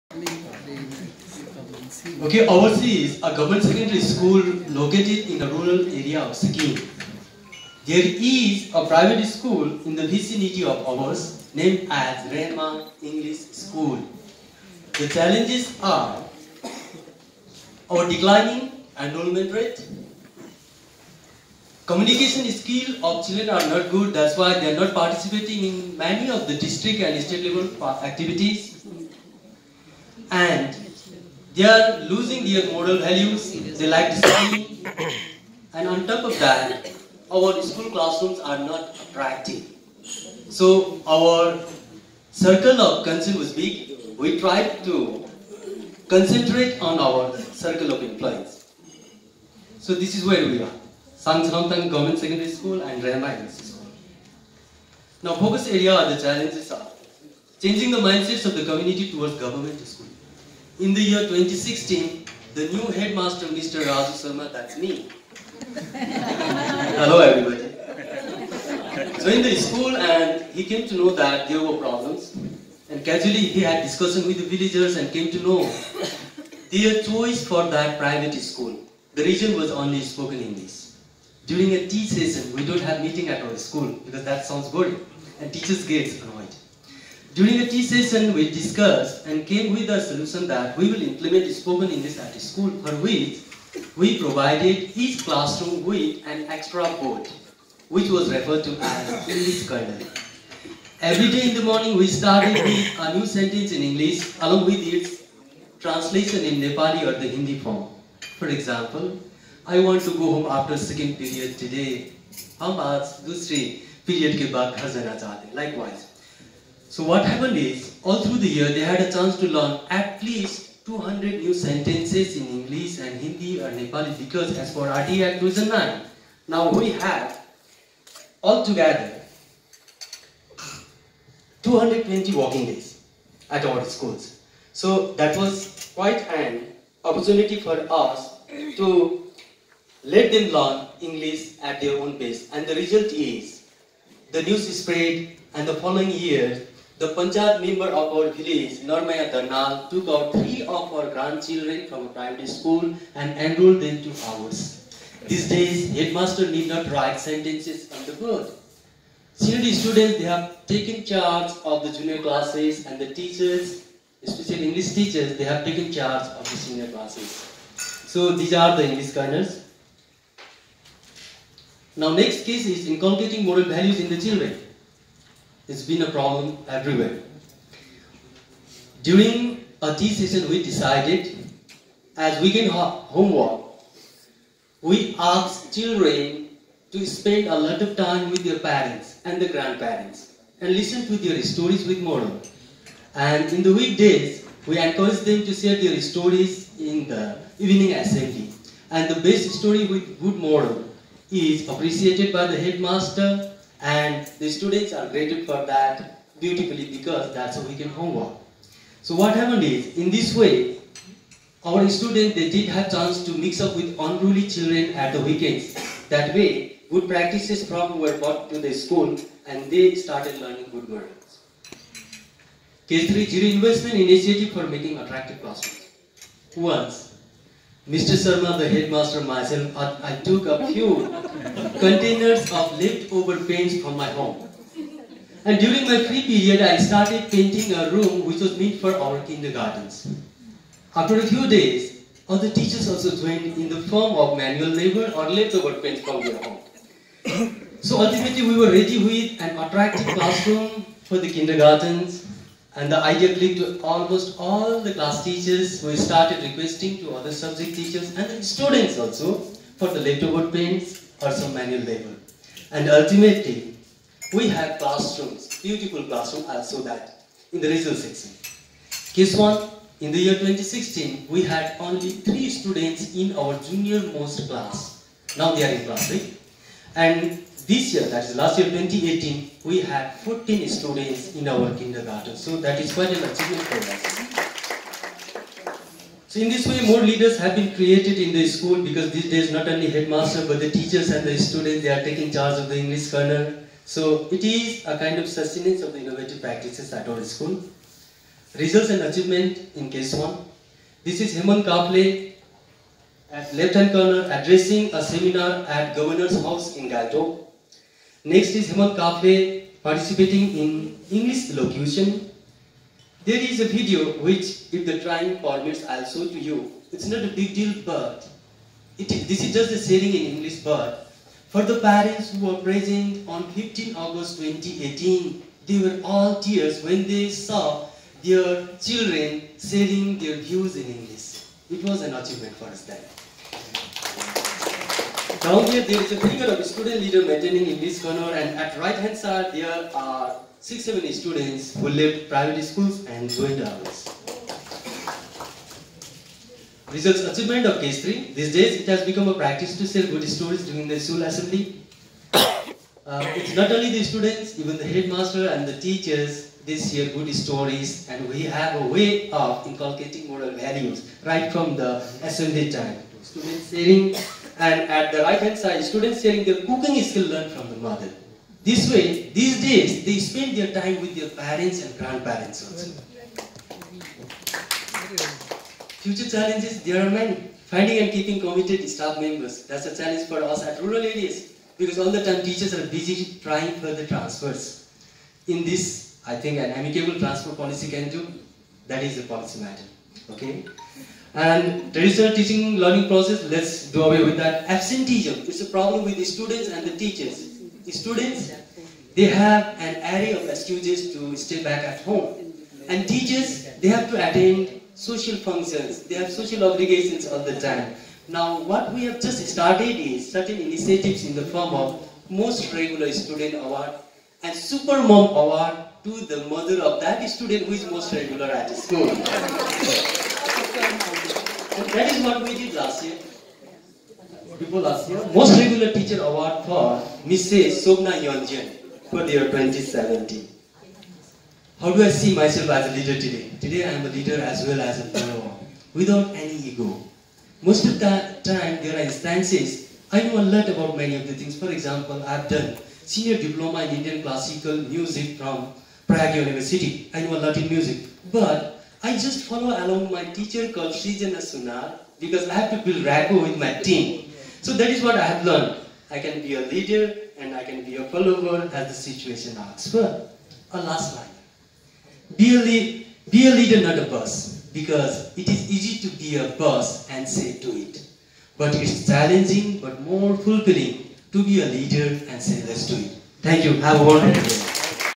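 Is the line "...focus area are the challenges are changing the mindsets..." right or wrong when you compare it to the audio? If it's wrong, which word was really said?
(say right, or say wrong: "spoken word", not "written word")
right.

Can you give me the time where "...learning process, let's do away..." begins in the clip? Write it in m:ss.
6:32.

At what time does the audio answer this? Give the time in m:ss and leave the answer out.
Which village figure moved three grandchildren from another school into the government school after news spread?
2:28.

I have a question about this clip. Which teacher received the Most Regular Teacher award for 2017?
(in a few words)
Sobna Yonjan.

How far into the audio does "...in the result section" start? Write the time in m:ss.
4:27.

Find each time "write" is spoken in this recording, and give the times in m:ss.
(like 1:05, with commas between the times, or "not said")
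2:36.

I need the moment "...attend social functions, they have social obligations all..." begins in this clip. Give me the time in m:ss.
6:44.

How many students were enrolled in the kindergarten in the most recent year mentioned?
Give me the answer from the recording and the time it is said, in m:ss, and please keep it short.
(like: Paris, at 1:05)
14, at 4:40.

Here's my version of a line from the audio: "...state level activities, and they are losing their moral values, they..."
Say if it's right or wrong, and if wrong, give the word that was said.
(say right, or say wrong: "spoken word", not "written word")
right.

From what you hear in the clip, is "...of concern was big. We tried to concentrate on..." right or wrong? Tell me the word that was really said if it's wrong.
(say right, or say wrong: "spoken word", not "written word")
right.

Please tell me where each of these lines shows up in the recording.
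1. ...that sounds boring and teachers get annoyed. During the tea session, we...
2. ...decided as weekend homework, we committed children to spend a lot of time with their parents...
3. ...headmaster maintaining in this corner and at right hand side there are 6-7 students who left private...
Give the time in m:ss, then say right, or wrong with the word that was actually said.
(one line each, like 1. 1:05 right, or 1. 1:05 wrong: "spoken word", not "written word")
1. 1:24 right
2. 3:00 wrong: "asked", not "committed"
3. 5:37 wrong: "leader", not "headmaster".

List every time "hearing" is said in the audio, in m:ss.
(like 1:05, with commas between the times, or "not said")
not said.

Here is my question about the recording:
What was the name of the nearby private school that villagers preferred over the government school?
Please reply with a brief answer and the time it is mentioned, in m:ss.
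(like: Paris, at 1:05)
Rema English School, at 0:12.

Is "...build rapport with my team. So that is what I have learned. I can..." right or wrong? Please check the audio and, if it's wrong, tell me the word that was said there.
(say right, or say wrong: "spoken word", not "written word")
right.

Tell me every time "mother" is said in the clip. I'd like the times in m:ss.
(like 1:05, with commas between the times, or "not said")
6:07, 6:56.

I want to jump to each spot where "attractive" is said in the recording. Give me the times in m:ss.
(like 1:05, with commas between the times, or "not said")
0:39, 3:44, 4:09.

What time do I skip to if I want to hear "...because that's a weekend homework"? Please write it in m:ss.
3:26.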